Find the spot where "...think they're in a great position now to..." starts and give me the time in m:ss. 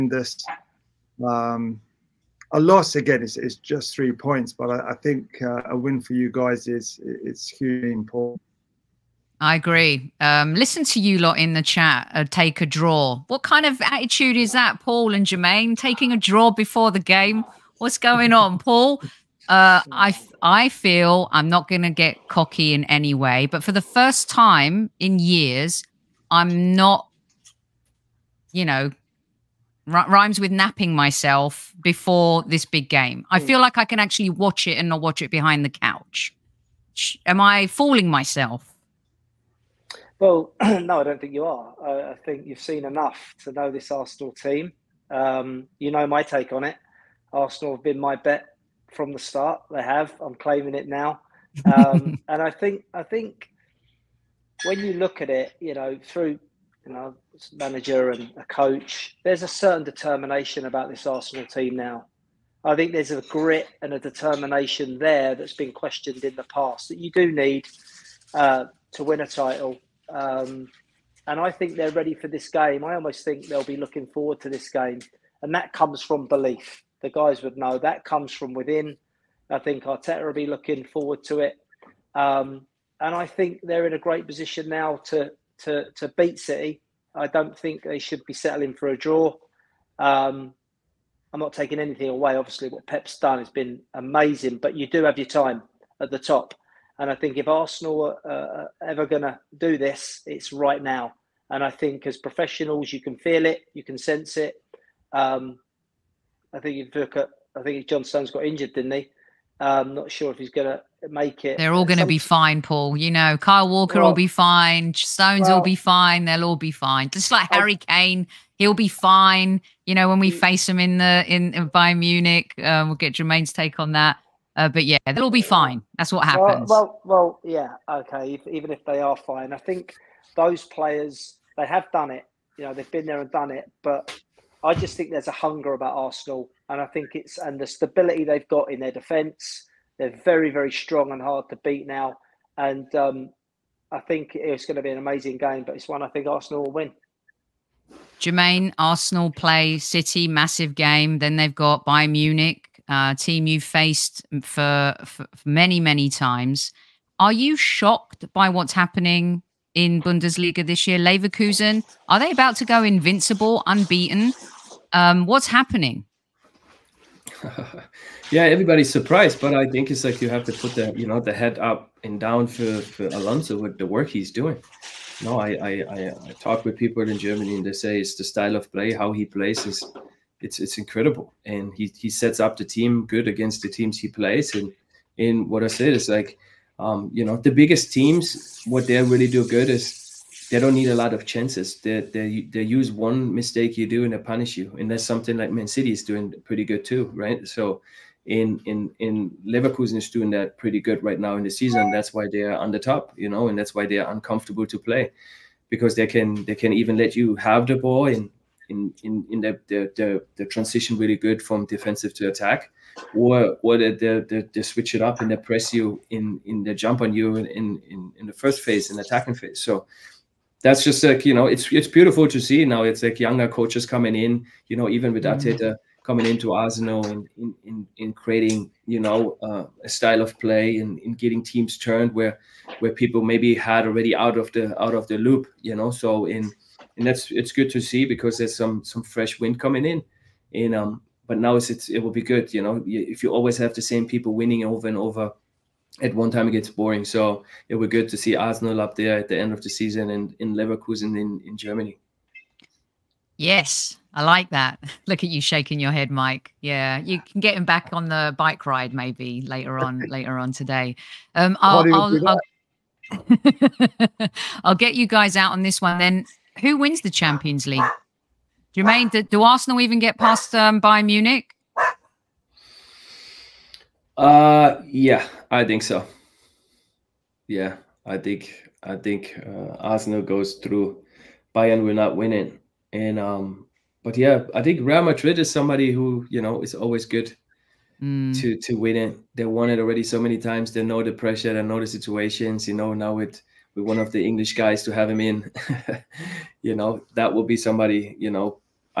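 1:23.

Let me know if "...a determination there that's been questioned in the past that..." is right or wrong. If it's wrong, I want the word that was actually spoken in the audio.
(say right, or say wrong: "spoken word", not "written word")
right.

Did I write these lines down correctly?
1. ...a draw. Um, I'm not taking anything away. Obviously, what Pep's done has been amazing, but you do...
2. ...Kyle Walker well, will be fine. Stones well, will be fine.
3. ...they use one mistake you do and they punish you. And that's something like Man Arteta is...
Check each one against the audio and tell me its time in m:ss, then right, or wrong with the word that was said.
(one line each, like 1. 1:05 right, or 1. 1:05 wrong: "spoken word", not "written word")
1. 1:28 right
2. 1:53 right
3. 3:12 wrong: "City", not "Arteta".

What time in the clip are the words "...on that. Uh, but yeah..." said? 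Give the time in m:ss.
2:03.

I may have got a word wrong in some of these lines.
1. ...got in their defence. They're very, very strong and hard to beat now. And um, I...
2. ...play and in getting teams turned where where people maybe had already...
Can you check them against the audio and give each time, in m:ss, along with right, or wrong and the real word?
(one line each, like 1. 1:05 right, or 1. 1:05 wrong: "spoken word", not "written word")
1. 2:18 right
2. 3:50 right.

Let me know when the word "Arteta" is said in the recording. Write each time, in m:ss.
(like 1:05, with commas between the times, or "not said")
1:19.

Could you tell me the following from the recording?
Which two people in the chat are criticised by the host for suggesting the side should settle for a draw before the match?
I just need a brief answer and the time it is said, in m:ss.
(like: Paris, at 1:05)
Paul and Jermaine, at 0:14.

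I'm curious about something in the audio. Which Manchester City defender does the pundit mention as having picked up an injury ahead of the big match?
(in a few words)
John Stones.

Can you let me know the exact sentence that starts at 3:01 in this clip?
And he he sets up the team good against the teams he plays.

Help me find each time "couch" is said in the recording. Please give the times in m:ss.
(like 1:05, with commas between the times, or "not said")
0:35.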